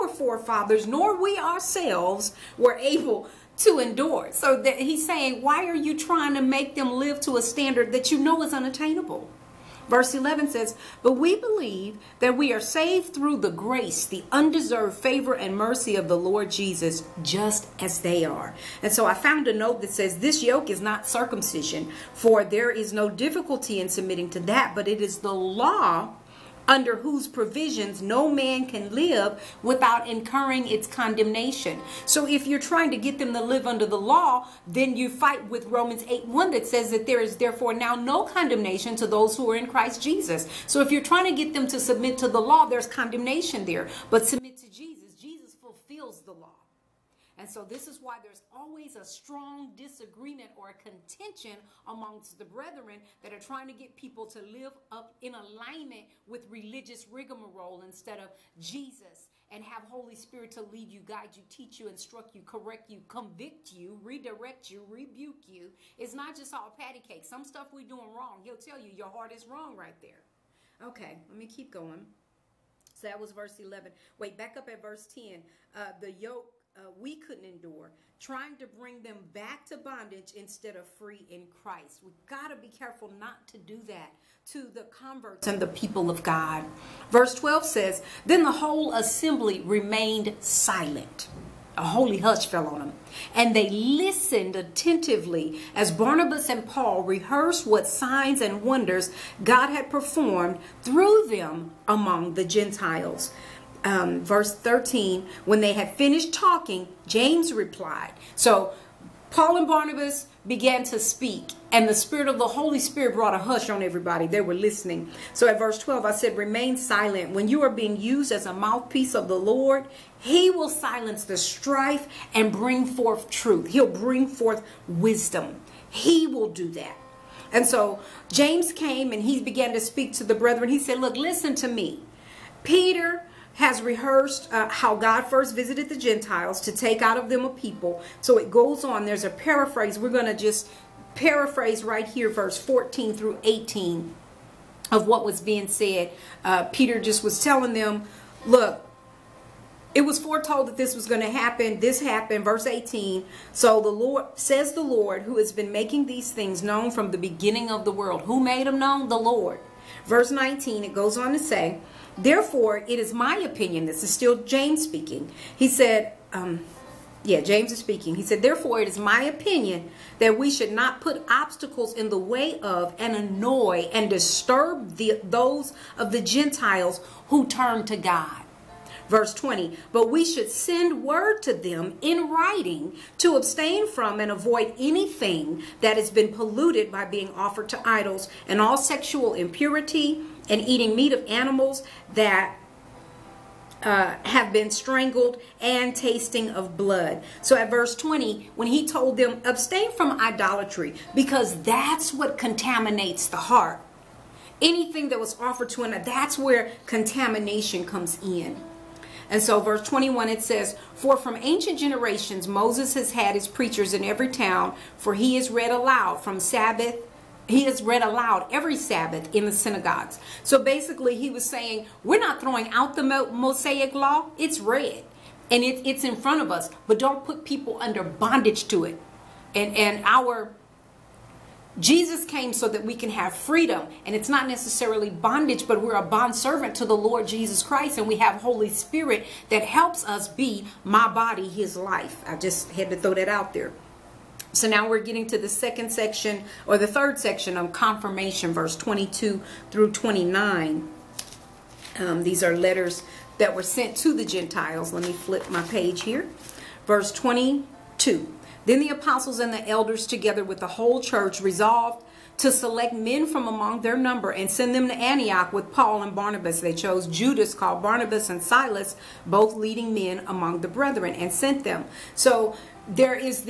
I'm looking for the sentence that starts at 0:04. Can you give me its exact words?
So that he's saying, why are you trying to make them live to a standard that you know is unattainable?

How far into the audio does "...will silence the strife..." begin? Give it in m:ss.
2:00.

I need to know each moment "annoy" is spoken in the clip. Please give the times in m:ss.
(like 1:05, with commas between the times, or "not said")
2:53.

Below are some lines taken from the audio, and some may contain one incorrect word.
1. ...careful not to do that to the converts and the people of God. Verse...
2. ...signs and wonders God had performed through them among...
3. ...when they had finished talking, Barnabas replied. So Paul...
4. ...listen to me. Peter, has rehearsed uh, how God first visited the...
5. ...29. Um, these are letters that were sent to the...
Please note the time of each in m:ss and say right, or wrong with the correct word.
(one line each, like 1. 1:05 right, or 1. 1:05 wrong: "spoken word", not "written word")
1. 1:22 right
2. 1:37 right
3. 1:45 wrong: "James", not "Barnabas"
4. 2:11 right
5. 4:09 right.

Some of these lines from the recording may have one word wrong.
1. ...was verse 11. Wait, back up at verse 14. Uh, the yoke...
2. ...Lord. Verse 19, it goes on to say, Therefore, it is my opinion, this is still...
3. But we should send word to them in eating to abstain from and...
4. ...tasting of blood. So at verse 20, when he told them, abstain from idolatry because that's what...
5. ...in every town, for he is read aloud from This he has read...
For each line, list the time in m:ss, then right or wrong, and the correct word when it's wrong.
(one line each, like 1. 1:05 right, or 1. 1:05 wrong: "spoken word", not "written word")
1. 1:13 wrong: "10", not "14"
2. 2:39 right
3. 2:59 wrong: "writing", not "eating"
4. 3:15 right
5. 3:33 wrong: "Sabbath", not "This".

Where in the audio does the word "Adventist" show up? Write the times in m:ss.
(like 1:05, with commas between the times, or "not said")
not said.